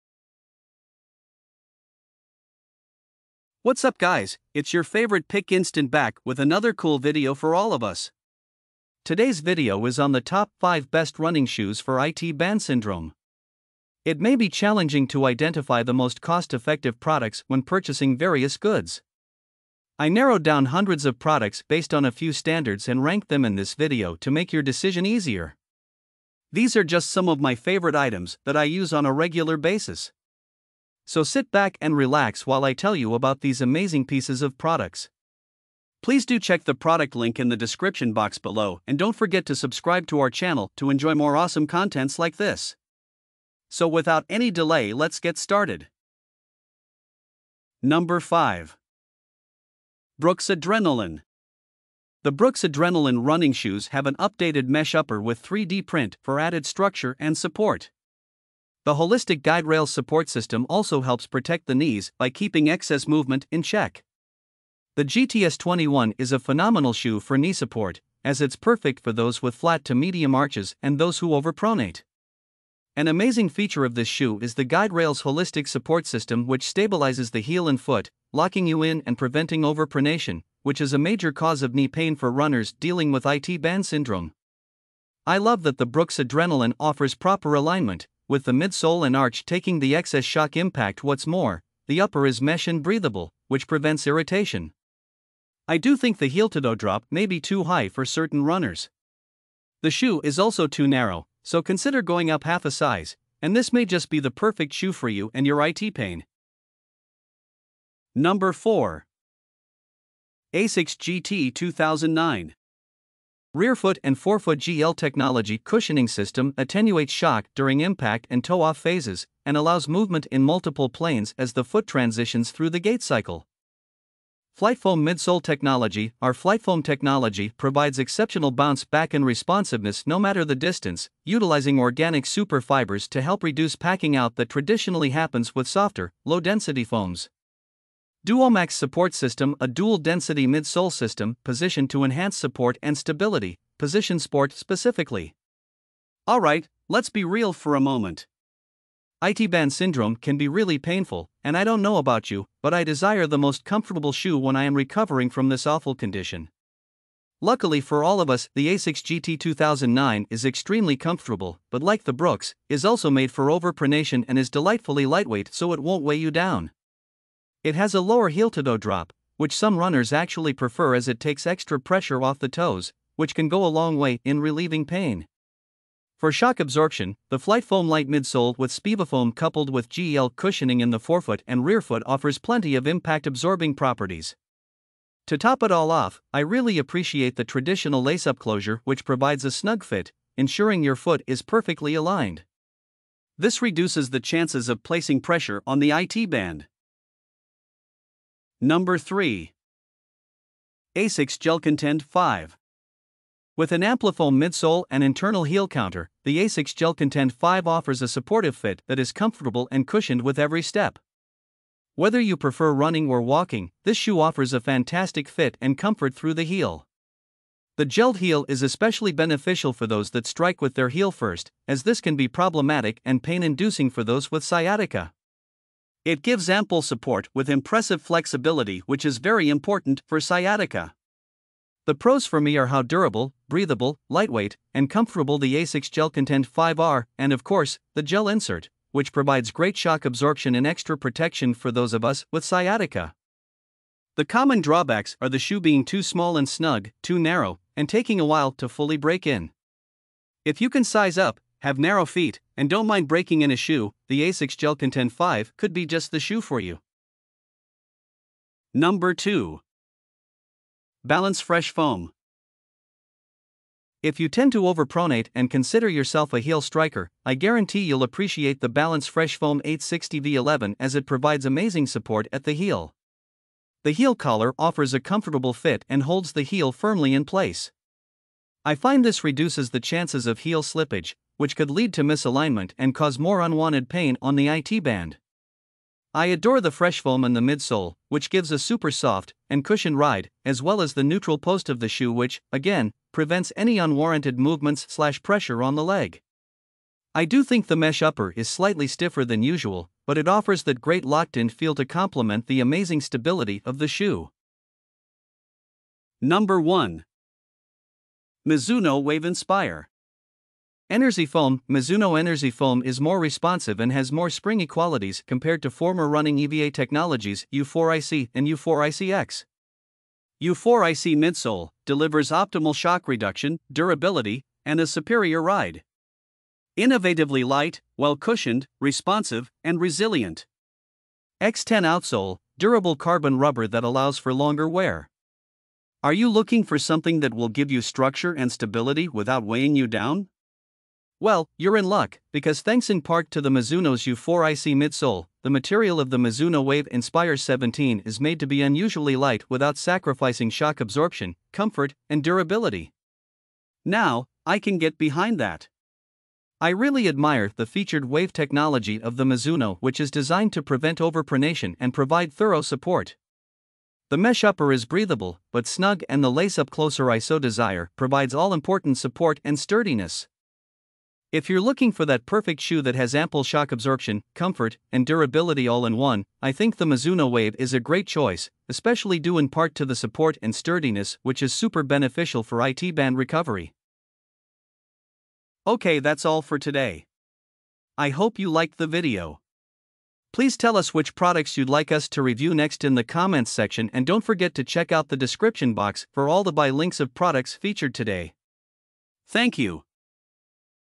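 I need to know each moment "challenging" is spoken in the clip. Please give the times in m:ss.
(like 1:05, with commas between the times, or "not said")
0:14.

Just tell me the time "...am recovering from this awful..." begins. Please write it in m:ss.
2:34.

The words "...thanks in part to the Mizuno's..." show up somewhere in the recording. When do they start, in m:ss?
5:42.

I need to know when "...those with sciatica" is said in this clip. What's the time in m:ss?
3:44.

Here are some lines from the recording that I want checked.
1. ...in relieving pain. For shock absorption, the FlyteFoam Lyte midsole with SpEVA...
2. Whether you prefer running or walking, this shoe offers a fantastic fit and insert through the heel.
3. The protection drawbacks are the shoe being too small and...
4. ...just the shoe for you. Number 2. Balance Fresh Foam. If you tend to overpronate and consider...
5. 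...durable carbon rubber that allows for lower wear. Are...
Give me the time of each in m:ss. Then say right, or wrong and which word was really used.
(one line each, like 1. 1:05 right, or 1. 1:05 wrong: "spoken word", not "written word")
1. 2:54 right
2. 3:31 wrong: "comfort", not "insert"
3. 4:04 wrong: "common", not "protection"
4. 4:15 right
5. 5:32 wrong: "longer", not "lower".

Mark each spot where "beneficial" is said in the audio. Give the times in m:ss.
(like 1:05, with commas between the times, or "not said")
3:39, 6:21.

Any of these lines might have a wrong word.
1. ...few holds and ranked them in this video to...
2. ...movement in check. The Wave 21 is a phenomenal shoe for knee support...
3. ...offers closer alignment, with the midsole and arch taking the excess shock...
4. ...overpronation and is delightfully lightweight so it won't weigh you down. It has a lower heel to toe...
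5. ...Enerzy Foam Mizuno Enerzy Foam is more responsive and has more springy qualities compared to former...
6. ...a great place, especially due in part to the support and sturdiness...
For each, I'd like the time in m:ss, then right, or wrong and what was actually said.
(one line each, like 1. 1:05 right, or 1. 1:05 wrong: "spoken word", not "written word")
1. 0:22 wrong: "standards", not "holds"
2. 1:03 wrong: "GTS", not "Wave"
3. 1:26 wrong: "proper", not "closer"
4. 2:43 right
5. 5:10 right
6. 6:17 wrong: "choice", not "place".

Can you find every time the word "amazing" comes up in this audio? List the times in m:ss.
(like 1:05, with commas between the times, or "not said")
0:33, 1:13, 4:31, 5:02.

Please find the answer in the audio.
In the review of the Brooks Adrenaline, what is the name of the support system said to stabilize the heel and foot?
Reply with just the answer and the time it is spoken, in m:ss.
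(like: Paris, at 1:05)
guide rail holistic support system, at 1:14.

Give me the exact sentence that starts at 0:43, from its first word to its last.
So without any delay let's get started.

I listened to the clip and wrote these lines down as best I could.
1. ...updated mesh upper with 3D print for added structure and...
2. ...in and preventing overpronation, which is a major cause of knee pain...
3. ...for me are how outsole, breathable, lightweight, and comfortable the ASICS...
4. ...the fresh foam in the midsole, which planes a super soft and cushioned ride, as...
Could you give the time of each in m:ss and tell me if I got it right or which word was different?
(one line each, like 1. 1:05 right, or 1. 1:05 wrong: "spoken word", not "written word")
1. 0:54 right
2. 1:18 right
3. 3:52 wrong: "durable", not "outsole"
4. 4:46 wrong: "gives", not "planes".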